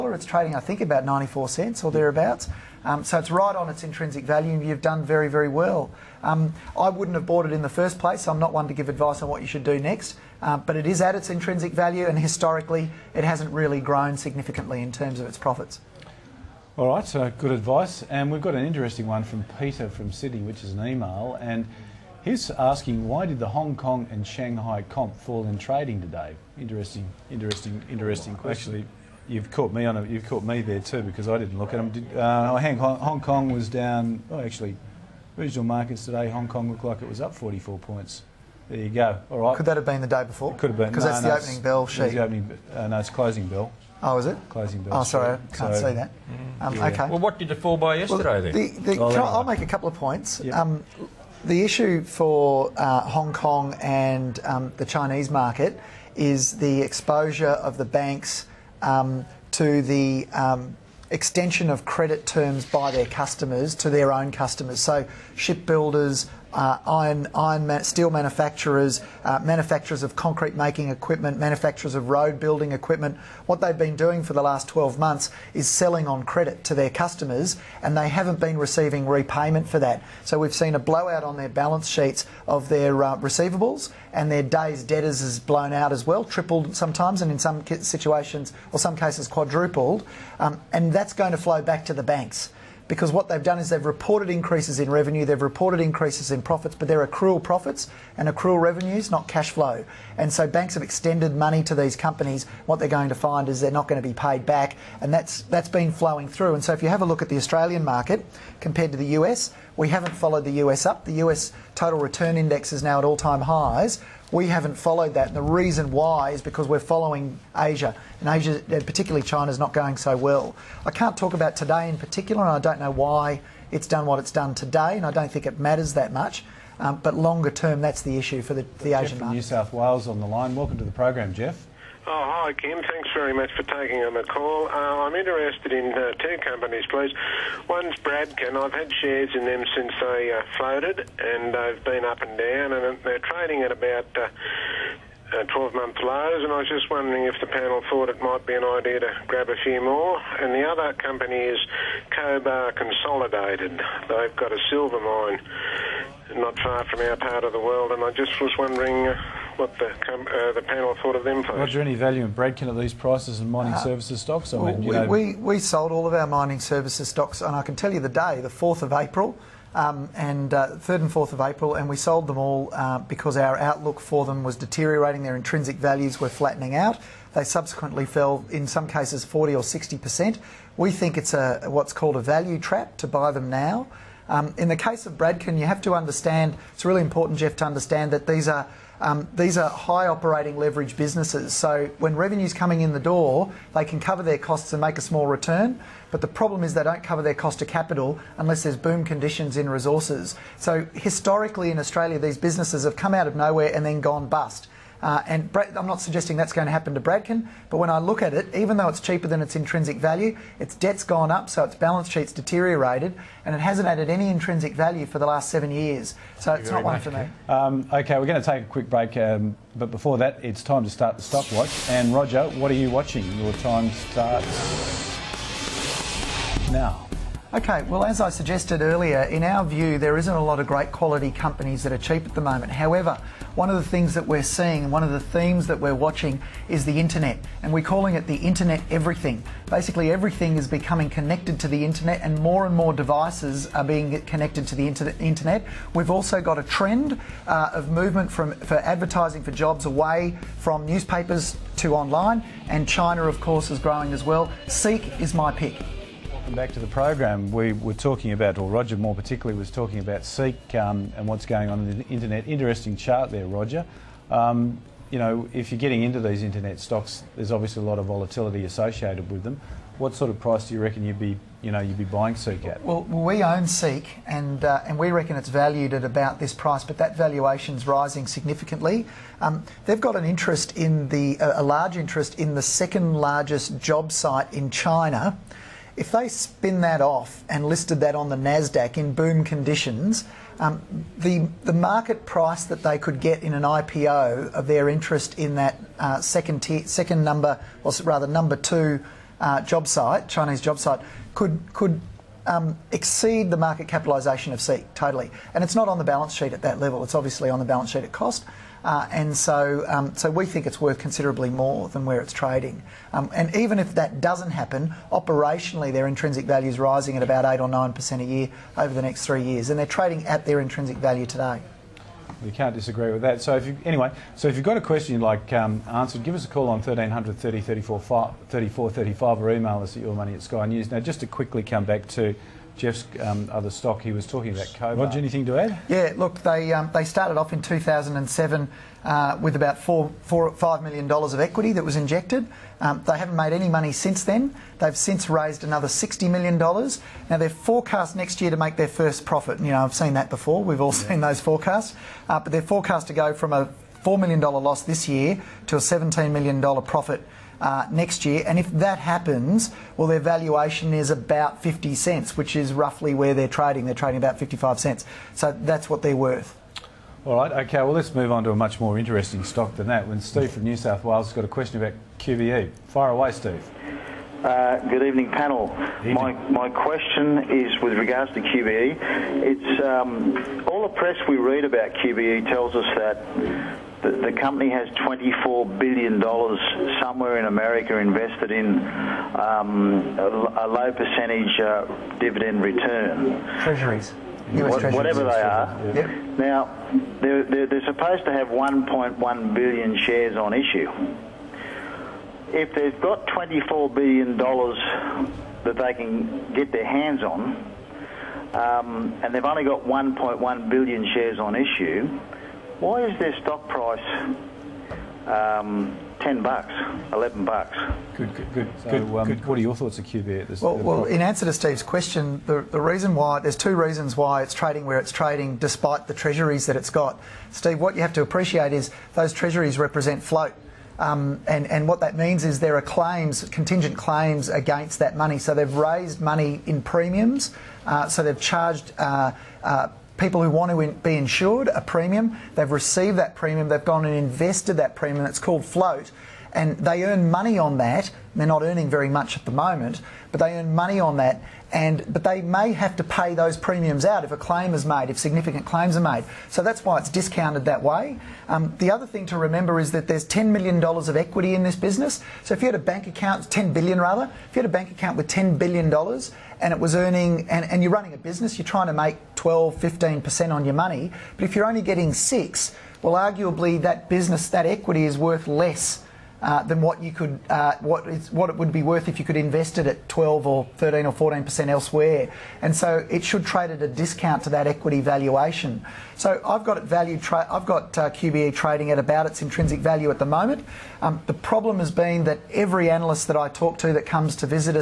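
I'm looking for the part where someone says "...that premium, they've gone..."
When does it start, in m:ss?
7:23.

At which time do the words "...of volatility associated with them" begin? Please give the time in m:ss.
4:27.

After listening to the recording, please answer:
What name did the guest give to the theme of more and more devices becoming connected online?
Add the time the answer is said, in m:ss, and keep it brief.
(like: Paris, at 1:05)
the internet everything, at 3:58.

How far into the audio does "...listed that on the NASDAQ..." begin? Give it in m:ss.
4:47.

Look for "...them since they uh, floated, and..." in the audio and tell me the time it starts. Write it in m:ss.
2:19.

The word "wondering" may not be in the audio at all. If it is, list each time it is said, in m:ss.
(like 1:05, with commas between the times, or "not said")
2:26, 2:38.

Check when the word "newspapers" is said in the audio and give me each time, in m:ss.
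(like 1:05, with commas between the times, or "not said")
4:10.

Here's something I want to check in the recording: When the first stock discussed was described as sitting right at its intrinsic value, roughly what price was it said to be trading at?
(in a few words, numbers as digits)
94 cents.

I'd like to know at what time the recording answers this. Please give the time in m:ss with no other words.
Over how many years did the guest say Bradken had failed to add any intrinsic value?
3:35.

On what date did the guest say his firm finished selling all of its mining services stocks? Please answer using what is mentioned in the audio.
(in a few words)
4th of April.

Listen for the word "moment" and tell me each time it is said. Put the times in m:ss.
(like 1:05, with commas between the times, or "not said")
3:52, 7:29, 8:10.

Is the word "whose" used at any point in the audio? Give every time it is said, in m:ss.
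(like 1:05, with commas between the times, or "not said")
not said.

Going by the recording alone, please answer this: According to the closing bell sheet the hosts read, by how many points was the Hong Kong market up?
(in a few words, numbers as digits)
44.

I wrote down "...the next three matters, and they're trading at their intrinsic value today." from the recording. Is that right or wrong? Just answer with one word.
wrong.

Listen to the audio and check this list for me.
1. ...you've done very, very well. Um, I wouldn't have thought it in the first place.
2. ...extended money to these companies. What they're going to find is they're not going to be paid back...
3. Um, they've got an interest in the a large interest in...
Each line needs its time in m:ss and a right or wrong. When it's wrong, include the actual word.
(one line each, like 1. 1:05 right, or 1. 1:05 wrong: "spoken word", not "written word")
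1. 0:04 wrong: "bought", not "thought"
2. 1:40 right
3. 4:39 right.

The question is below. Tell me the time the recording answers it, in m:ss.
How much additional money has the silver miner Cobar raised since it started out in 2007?
5:45.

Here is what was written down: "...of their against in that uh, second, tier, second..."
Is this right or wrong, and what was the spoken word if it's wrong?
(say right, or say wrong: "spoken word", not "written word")
wrong: "interest", not "against".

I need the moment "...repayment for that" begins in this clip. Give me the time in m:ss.
1:19.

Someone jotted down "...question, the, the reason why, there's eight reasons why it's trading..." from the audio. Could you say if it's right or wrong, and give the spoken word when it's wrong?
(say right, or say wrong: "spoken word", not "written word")
wrong: "two", not "eight".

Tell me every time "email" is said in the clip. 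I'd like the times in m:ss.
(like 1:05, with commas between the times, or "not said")
0:20, 5:29.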